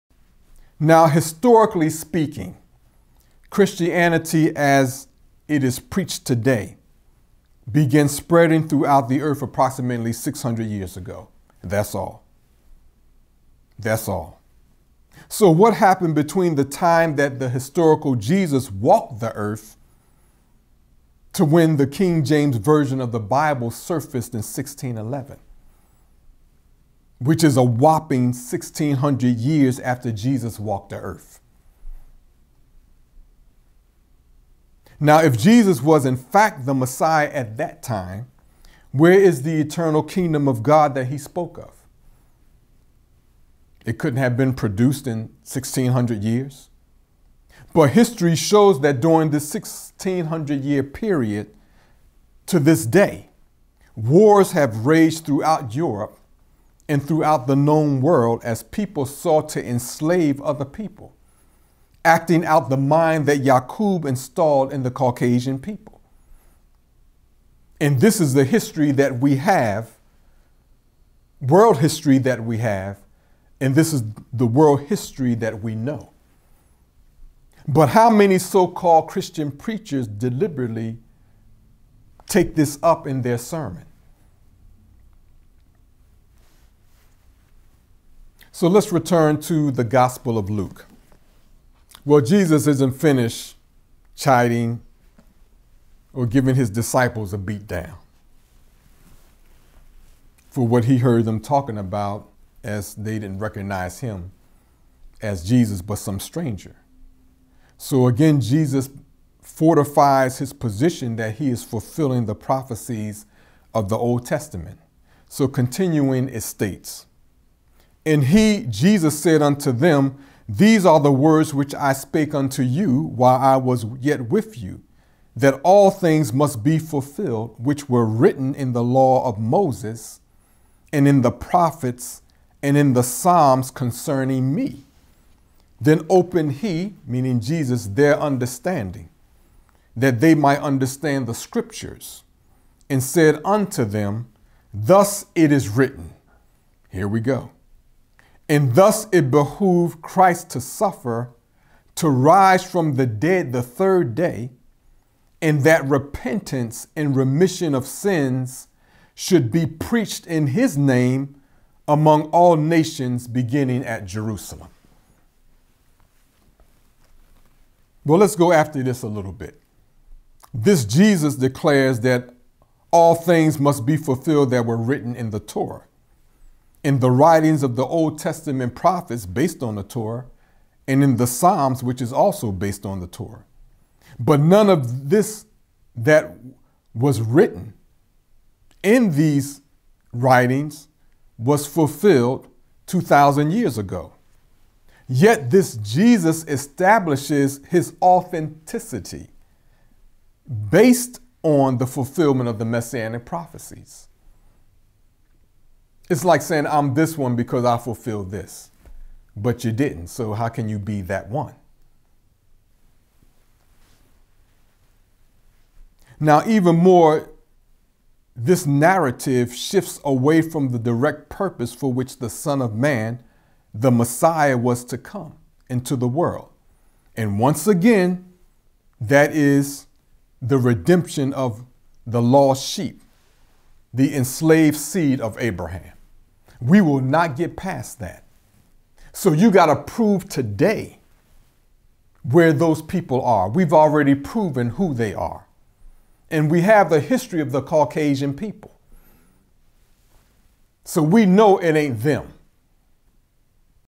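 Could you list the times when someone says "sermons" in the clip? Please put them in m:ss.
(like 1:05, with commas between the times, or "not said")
1:23.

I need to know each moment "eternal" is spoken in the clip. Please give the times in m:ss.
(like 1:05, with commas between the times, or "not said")
0:39.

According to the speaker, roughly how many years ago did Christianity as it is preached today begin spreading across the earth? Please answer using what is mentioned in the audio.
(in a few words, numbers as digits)
600 years.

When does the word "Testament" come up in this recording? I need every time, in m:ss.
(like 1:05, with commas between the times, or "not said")
1:54, 2:58.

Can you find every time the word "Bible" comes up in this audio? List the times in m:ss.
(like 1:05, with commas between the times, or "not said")
0:23.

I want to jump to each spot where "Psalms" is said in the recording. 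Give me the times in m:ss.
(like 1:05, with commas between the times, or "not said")
2:13, 3:01.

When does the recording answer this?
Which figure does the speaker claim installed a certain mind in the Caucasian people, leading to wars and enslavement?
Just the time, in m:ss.
1:03.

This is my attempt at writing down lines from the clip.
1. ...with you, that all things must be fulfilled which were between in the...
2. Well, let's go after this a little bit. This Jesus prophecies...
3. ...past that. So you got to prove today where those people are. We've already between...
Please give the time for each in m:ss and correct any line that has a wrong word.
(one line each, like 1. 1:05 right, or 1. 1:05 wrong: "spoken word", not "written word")
1. 2:04 wrong: "written", not "between"
2. 2:48 wrong: "declares", not "prophecies"
3. 3:57 wrong: "proven", not "between".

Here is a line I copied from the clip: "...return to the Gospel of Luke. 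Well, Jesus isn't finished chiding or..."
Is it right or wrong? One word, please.
right.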